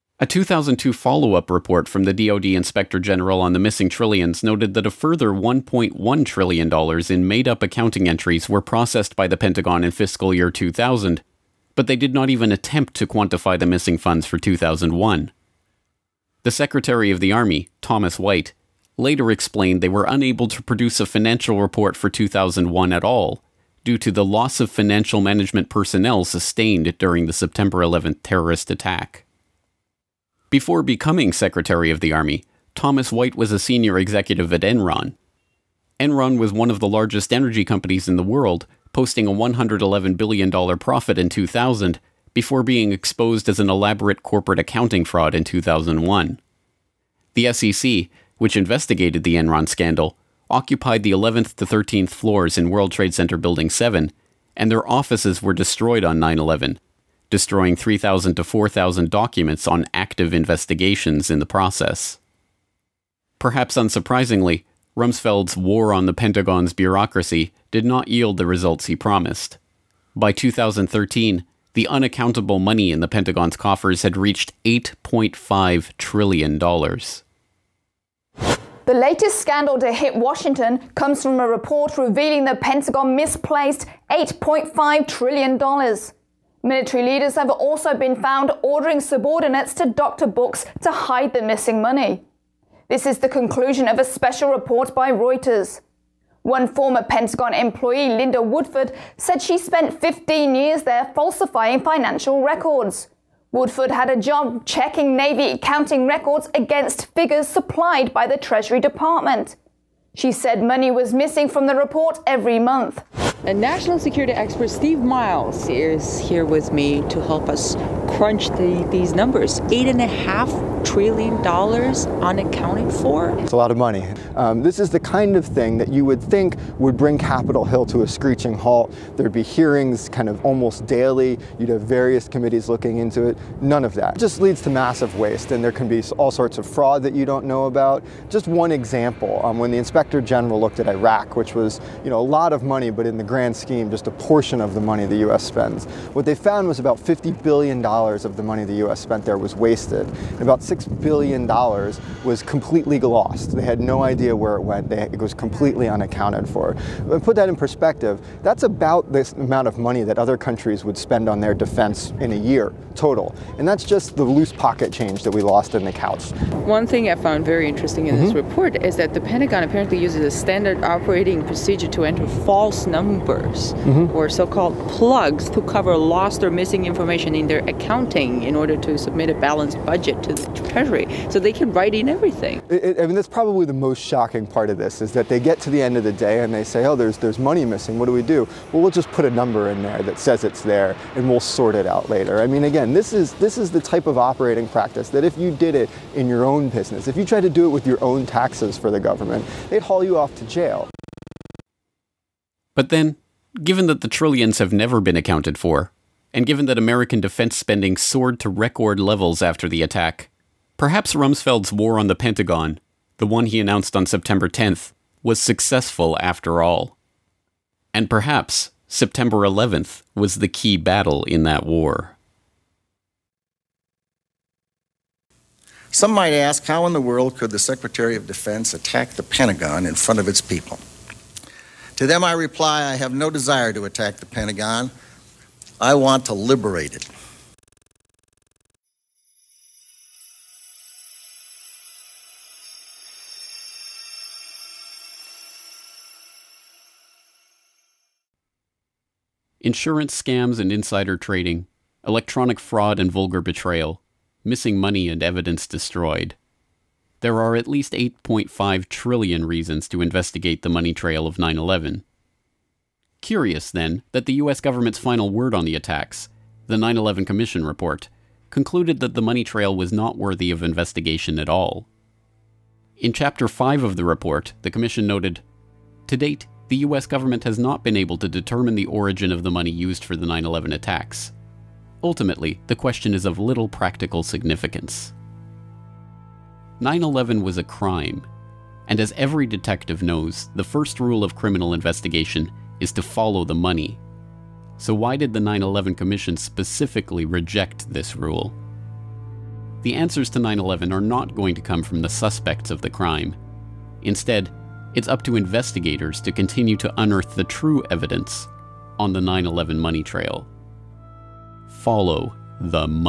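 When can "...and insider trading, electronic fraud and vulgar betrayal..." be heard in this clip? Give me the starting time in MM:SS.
04:10.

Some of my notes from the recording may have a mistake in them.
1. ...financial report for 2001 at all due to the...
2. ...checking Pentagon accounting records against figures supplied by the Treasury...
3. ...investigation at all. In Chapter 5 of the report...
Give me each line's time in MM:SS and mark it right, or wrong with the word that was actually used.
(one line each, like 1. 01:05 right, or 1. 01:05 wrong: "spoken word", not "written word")
1. 00:21 right
2. 01:44 wrong: "Navy", not "Pentagon"
3. 04:30 right.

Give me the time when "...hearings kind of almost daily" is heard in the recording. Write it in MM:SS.
02:09.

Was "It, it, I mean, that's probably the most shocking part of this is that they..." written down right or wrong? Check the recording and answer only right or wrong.
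right.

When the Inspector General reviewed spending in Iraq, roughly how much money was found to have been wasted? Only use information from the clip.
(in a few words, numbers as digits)
$50 billion.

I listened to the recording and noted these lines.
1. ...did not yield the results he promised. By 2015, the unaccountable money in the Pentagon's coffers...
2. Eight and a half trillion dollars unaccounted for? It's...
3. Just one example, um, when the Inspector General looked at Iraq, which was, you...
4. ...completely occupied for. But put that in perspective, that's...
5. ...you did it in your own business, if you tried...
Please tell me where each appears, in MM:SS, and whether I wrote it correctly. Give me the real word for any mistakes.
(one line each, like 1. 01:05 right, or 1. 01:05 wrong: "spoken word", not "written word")
1. 01:07 wrong: "2013", not "2015"
2. 01:59 right
3. 02:18 right
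4. 02:35 wrong: "unaccounted", not "occupied"
5. 03:15 right.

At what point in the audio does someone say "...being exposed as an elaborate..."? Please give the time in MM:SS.
00:42.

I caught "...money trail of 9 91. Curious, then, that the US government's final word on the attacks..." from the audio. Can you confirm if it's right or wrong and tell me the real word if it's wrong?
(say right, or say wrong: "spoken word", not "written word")
wrong: "11", not "91".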